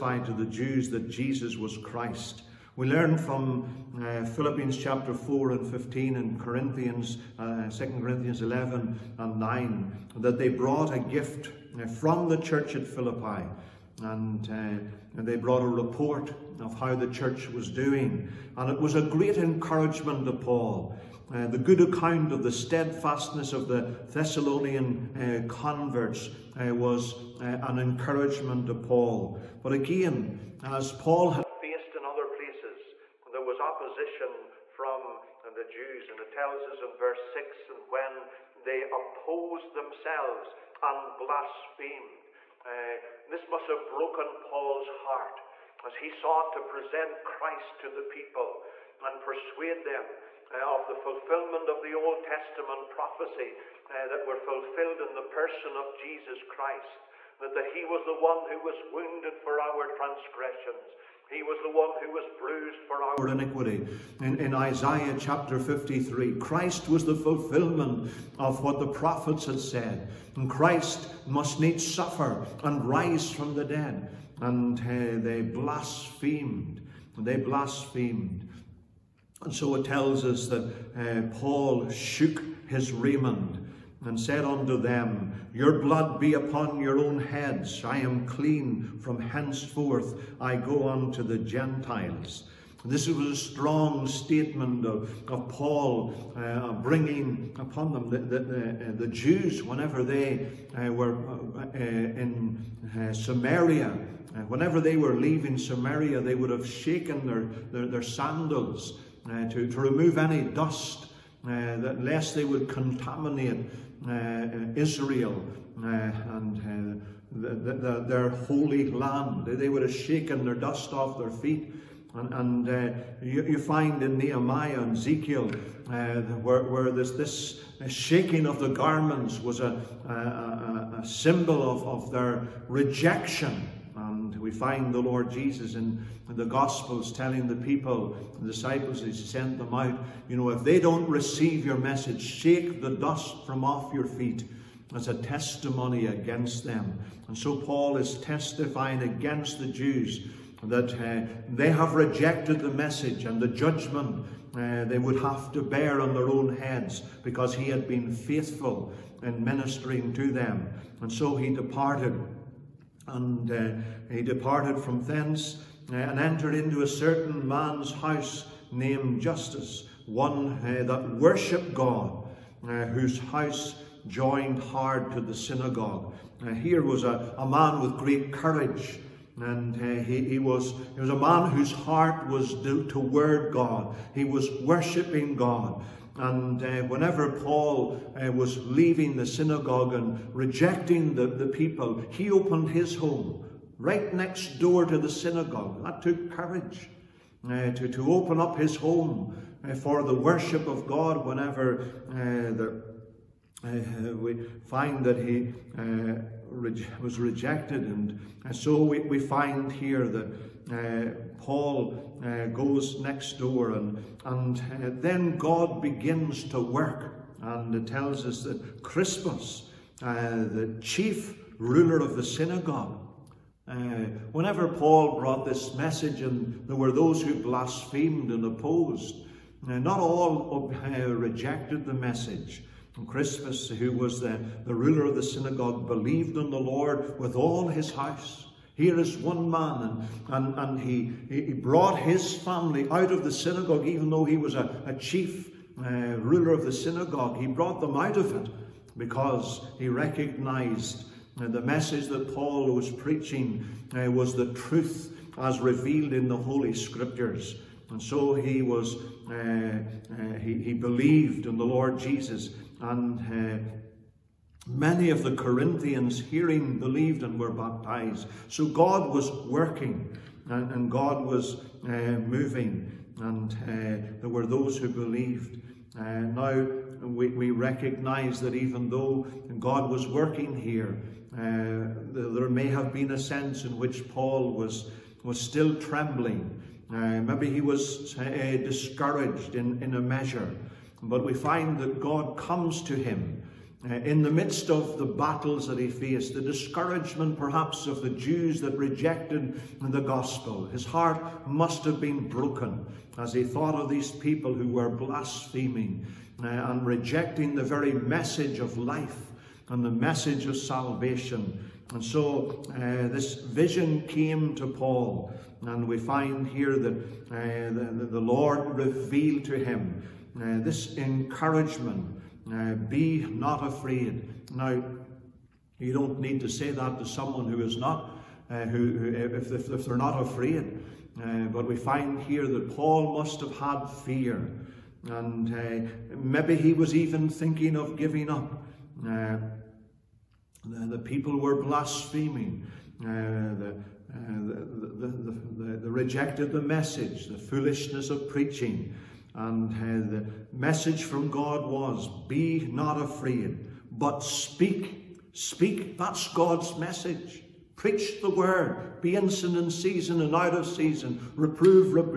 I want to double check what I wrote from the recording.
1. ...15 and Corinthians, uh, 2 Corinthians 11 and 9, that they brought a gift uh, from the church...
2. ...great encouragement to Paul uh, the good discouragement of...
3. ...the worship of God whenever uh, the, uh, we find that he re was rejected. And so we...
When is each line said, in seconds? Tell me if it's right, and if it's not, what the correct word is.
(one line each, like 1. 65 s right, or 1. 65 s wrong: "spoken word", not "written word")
1. 5 s right
2. 19 s wrong: "account", not "discouragement"
3. 200 s right.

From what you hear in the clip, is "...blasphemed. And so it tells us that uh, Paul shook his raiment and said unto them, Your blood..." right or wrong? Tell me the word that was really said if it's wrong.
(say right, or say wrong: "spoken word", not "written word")
right.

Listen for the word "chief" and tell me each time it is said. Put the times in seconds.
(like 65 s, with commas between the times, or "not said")
220 s, 244 s.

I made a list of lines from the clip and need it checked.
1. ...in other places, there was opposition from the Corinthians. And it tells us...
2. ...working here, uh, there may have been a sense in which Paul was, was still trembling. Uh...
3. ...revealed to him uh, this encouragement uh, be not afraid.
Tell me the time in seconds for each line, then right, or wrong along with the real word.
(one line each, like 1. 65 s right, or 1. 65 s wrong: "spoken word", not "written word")
1. 31 s wrong: "Jews", not "Corinthians"
2. 280 s right
3. 318 s right.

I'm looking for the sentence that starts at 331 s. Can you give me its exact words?
Uh, but we find here that Paul must have had fear, and maybe he was even thinking of giving up.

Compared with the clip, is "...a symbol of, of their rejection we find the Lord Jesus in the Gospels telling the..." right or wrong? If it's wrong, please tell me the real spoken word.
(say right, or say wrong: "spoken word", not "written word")
right.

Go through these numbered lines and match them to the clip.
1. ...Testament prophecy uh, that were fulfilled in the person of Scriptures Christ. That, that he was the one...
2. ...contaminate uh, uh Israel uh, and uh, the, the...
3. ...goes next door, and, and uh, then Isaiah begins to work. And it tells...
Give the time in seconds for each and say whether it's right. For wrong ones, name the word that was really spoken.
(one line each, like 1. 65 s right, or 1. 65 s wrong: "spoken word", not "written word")
1. 52 s wrong: "Jesus", not "Scriptures"
2. 112 s right
3. 212 s wrong: "God", not "Isaiah".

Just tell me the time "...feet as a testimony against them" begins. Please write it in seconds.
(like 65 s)
144 s.